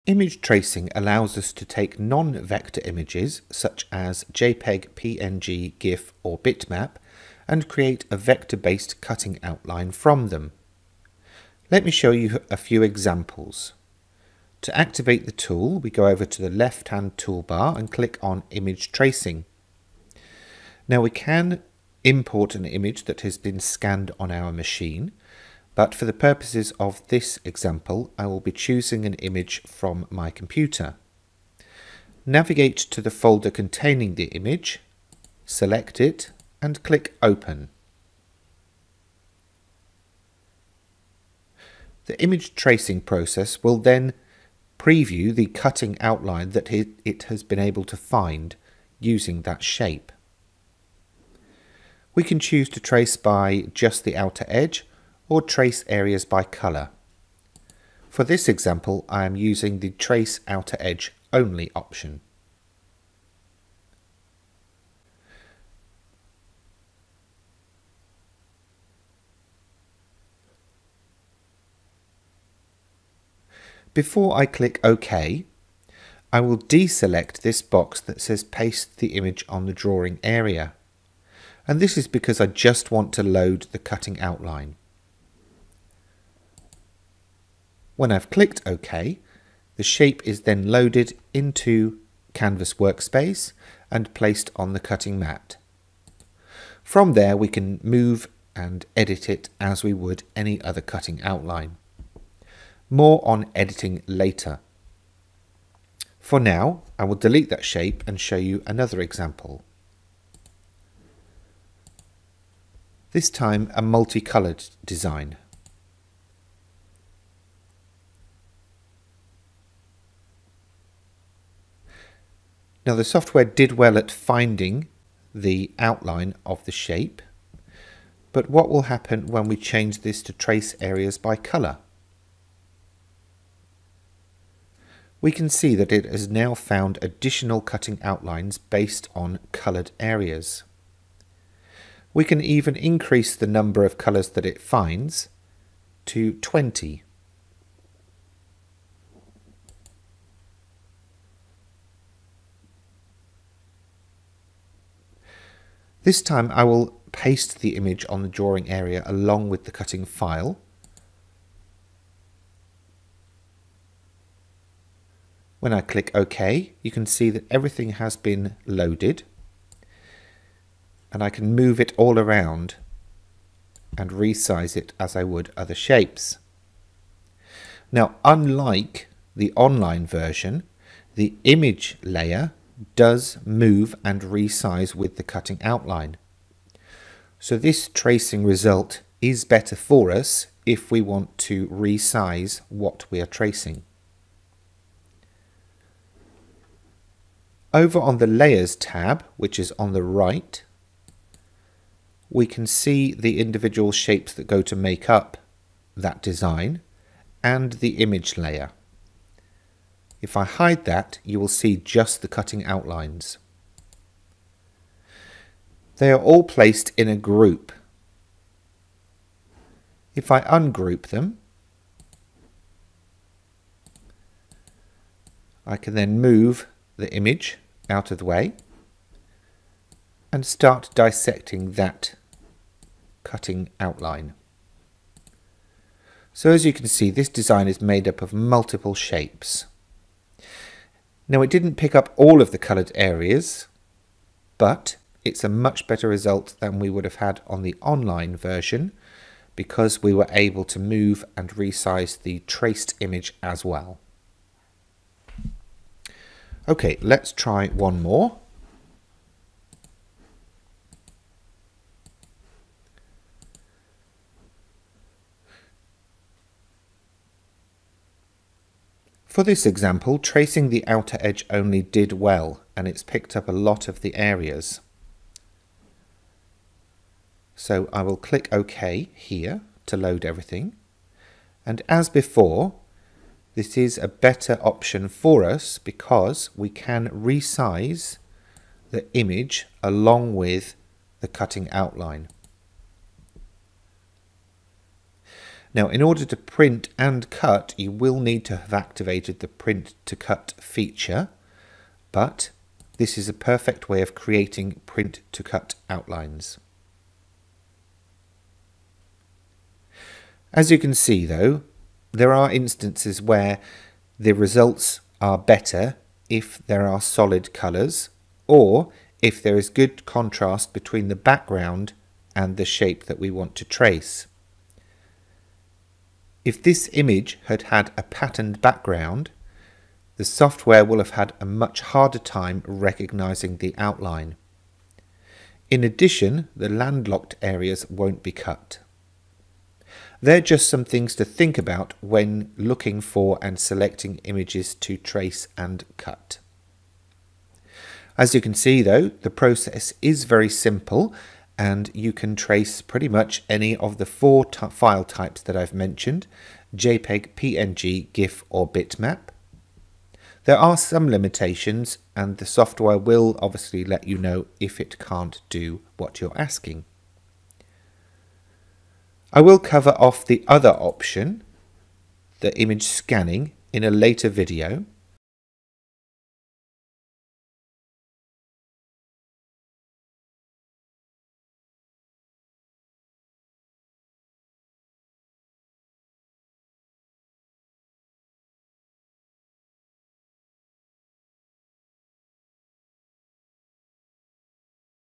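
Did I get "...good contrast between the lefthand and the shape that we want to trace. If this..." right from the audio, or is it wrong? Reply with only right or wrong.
wrong.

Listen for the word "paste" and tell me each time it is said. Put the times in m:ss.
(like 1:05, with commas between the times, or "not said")
1:18, 2:37.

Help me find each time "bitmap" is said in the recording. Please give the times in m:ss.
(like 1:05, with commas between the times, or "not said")
0:06, 5:58.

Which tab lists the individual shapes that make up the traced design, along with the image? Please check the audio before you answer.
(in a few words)
Layers tab.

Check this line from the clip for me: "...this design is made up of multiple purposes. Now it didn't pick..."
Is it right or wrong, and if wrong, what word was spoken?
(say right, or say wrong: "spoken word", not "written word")
wrong: "shapes", not "purposes".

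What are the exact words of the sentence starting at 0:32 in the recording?
Navigate to the folder containing the image, select it and click Open.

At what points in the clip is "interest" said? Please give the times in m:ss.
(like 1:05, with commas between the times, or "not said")
not said.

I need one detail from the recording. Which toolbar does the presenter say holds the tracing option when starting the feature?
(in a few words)
left-hand toolbar.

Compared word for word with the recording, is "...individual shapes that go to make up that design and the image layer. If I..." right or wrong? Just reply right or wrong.
right.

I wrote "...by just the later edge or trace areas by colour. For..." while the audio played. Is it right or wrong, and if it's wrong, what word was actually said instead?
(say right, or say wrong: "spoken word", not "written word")
wrong: "outer", not "later".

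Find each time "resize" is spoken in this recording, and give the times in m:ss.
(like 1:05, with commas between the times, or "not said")
2:54, 3:04, 3:11, 4:11, 4:47.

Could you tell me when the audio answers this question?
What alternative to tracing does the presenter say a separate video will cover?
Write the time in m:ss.
6:12.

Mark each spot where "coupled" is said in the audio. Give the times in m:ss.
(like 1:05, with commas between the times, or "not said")
not said.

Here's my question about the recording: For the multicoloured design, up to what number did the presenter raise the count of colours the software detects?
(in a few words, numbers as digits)
20.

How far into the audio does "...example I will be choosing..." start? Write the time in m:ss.
0:27.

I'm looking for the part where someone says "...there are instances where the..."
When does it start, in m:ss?
5:12.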